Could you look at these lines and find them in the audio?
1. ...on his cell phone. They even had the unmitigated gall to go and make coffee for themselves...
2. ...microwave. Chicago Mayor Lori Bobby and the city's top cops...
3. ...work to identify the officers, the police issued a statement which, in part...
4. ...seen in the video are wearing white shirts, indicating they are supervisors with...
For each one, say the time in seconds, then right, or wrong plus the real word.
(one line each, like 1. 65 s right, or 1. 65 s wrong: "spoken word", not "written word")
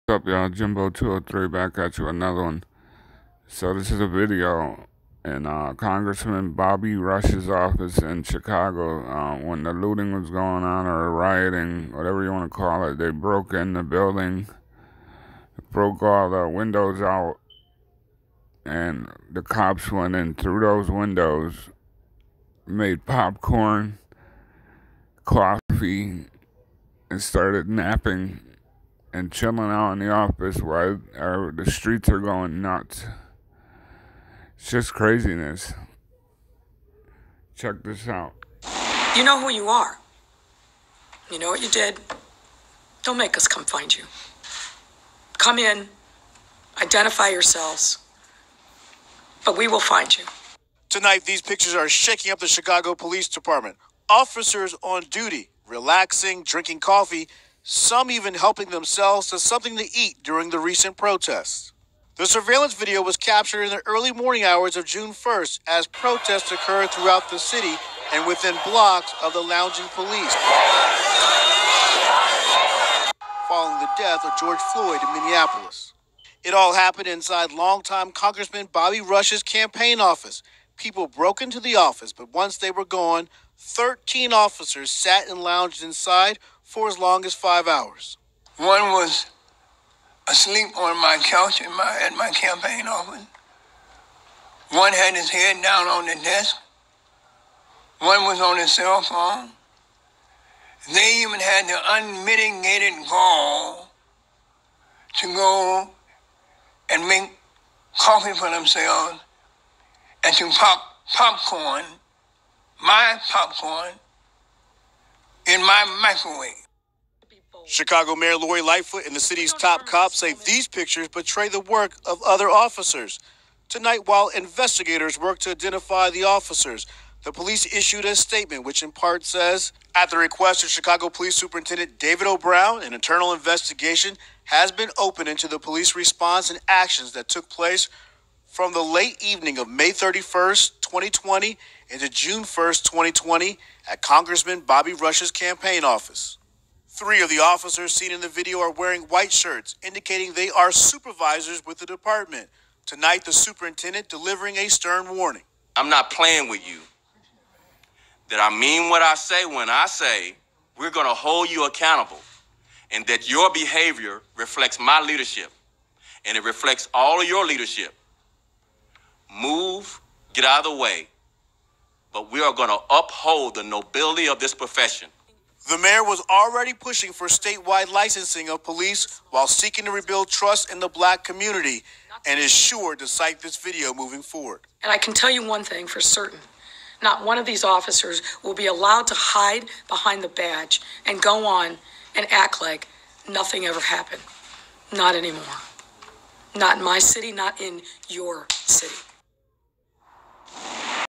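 1. 98 s right
2. 116 s wrong: "Lightfoot", not "Bobby"
3. 125 s right
4. 147 s right.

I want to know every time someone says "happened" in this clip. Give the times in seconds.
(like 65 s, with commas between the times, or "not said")
76 s, 193 s.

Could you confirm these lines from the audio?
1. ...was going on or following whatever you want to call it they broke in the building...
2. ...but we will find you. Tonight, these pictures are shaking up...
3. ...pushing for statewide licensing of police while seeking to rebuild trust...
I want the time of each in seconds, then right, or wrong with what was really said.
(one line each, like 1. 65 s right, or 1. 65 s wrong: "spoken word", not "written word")
1. 10 s wrong: "rioting", not "following"
2. 49 s right
3. 176 s right.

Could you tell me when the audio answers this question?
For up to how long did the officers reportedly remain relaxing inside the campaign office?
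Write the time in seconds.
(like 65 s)
87 s.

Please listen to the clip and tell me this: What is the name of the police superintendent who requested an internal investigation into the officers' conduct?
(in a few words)
David O. Brown.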